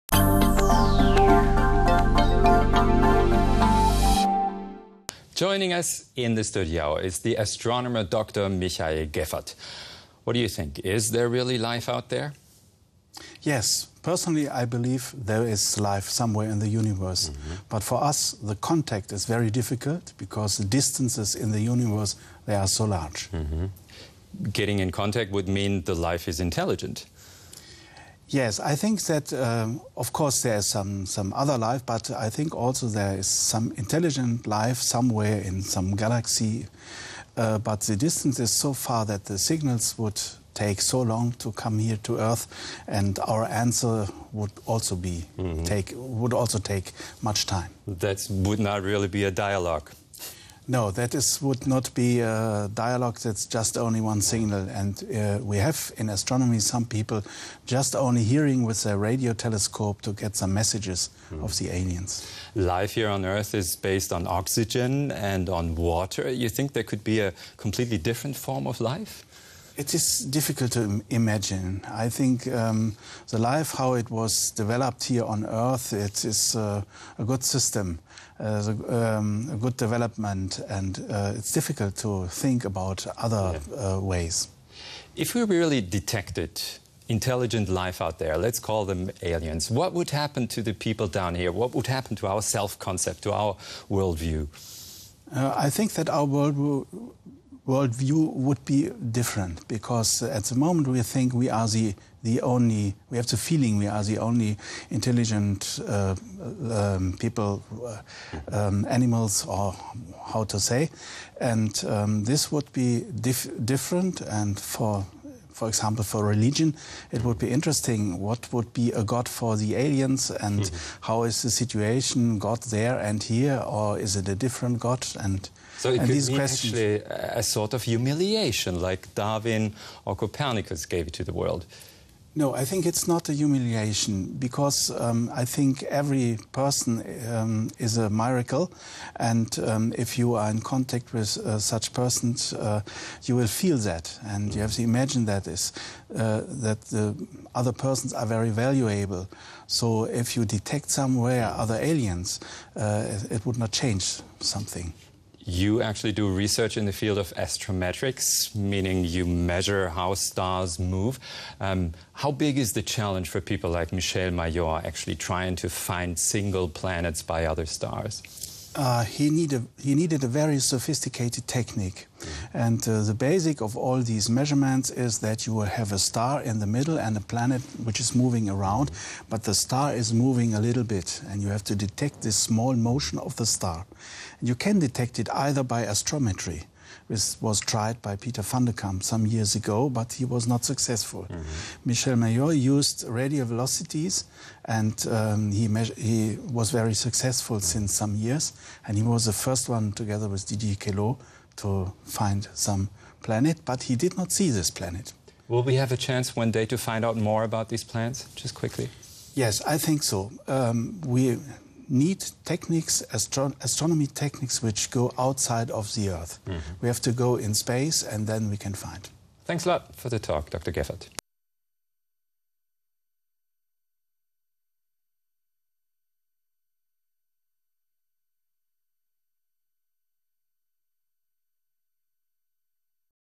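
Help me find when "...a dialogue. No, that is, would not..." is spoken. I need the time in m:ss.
0:49.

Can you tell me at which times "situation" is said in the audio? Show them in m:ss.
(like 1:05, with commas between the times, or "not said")
2:01.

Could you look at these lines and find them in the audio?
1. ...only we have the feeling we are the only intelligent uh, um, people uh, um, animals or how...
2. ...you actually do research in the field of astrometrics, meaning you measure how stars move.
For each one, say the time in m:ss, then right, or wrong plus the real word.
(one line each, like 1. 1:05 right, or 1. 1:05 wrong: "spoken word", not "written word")
1. 1:42 right
2. 2:35 right.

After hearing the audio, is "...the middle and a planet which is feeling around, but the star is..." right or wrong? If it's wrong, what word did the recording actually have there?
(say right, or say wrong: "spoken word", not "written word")
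wrong: "moving", not "feeling".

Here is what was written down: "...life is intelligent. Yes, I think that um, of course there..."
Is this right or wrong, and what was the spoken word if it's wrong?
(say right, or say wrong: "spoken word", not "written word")
right.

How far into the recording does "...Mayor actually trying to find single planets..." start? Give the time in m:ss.
2:44.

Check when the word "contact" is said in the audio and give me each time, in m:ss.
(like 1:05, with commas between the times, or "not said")
0:18, 0:24, 2:20.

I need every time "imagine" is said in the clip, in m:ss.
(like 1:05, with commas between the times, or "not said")
1:11, 2:24.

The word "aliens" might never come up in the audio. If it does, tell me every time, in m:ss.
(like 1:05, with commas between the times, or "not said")
1:01, 1:29, 1:59, 2:31.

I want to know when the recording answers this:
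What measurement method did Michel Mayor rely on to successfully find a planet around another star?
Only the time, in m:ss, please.
3:13.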